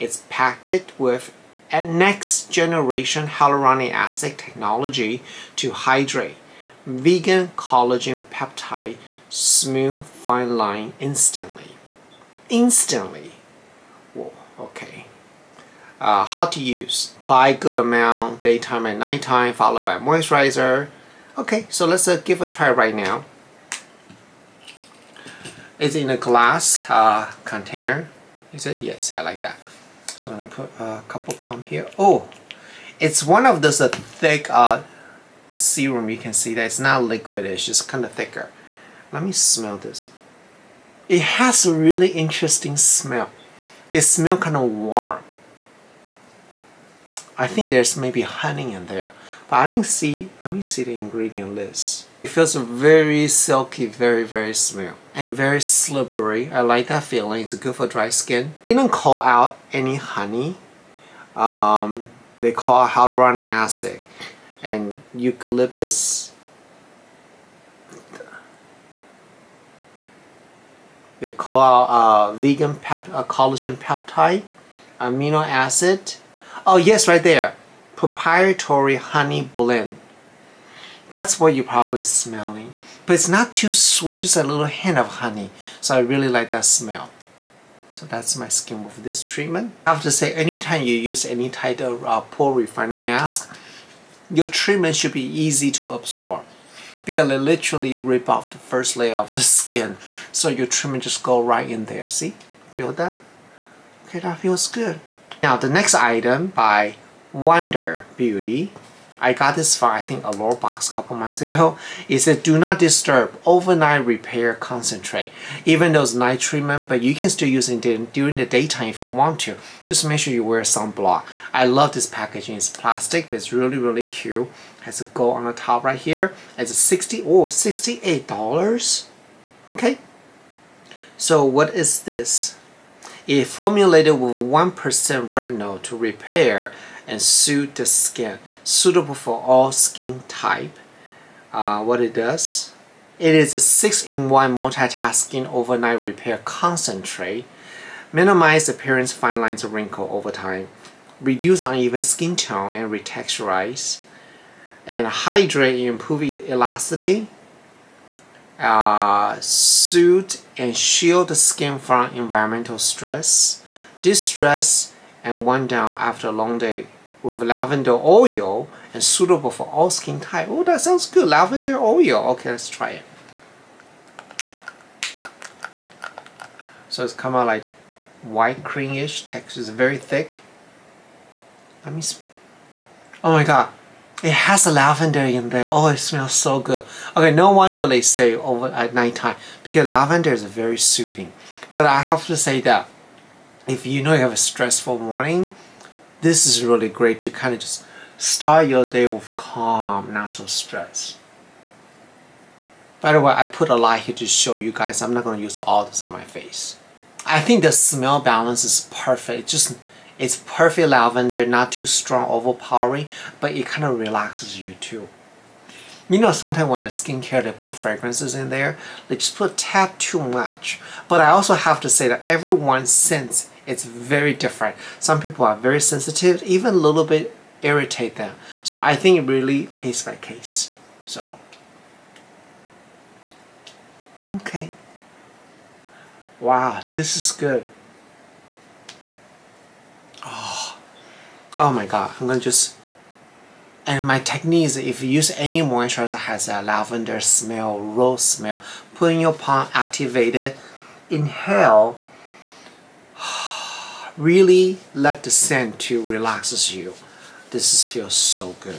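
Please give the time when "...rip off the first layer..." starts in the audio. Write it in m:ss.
1:37.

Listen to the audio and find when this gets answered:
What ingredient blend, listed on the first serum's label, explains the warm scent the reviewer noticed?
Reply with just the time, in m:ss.
1:17.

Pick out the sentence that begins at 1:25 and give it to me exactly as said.
So I really like that smell.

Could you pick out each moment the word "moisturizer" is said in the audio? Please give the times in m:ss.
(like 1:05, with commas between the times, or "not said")
0:19, 4:05.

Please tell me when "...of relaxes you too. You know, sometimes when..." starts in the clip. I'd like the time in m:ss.
3:33.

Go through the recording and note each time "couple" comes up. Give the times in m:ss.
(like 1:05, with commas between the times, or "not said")
0:31, 1:50.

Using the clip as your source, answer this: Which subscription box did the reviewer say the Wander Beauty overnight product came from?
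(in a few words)
Allure box.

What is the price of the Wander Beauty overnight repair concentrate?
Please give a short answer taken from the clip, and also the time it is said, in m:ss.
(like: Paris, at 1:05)
$68, at 2:07.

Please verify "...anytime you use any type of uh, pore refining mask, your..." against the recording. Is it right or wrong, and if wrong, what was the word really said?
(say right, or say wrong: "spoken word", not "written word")
right.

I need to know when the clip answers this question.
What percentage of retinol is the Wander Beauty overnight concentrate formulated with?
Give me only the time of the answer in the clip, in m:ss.
2:14.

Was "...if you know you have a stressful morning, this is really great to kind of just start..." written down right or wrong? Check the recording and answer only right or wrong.
right.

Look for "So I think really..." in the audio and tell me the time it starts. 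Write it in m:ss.
3:48.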